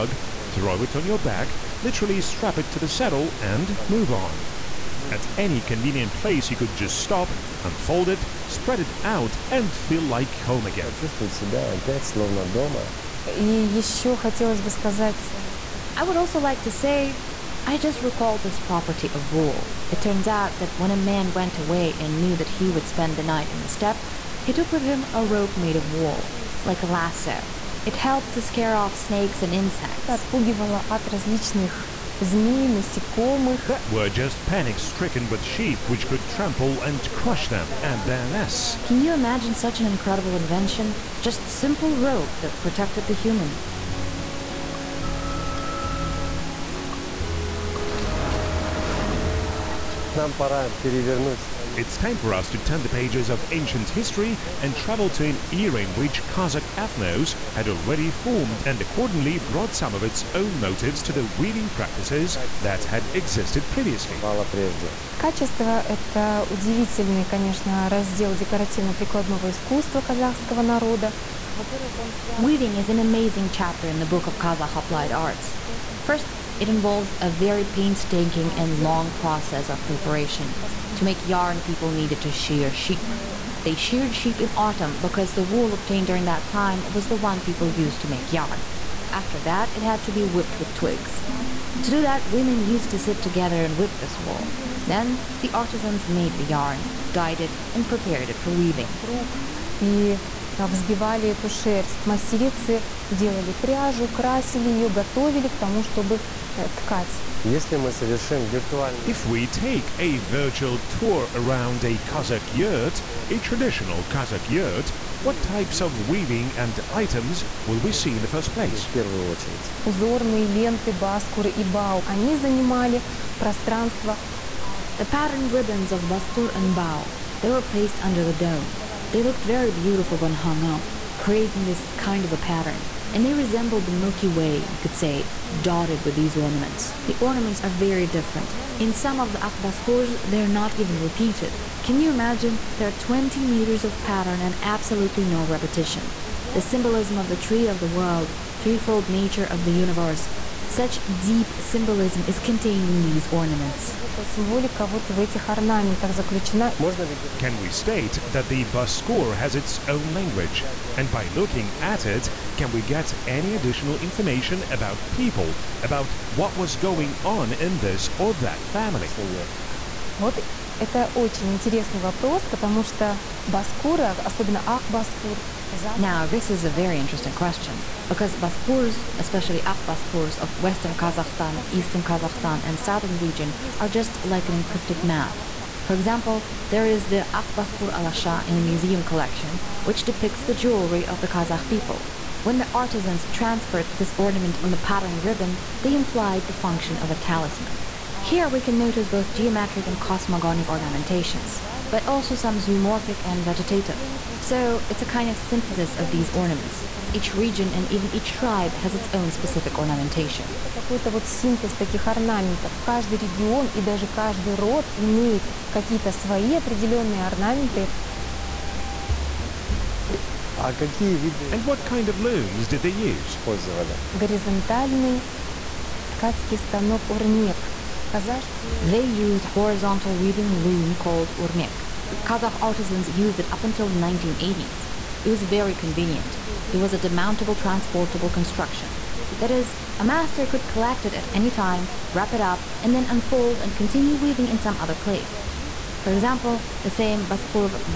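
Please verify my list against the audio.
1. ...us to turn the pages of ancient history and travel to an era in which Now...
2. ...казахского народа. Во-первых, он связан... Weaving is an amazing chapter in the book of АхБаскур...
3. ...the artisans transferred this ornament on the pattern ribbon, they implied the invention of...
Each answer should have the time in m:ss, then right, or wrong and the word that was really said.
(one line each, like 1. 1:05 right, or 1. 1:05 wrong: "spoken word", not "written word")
1. 0:52 wrong: "Kazakh", not "Now"
2. 1:09 wrong: "Kazakh", not "АхБаскур"
3. 3:12 wrong: "function", not "invention".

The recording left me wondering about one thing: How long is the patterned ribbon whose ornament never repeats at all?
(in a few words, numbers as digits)
20 meters.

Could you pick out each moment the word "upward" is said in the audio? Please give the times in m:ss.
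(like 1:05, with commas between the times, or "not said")
not said.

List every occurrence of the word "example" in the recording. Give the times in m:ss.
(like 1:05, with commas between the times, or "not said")
3:05, 4:06.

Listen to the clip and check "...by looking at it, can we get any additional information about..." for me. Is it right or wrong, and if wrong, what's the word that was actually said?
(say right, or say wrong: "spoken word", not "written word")
right.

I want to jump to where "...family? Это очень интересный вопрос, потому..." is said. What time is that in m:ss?
2:48.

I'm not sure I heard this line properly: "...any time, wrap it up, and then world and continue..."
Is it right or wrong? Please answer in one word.
wrong.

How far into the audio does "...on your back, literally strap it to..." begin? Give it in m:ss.
0:00.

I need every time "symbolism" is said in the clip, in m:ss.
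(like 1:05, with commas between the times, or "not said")
2:26, 2:31.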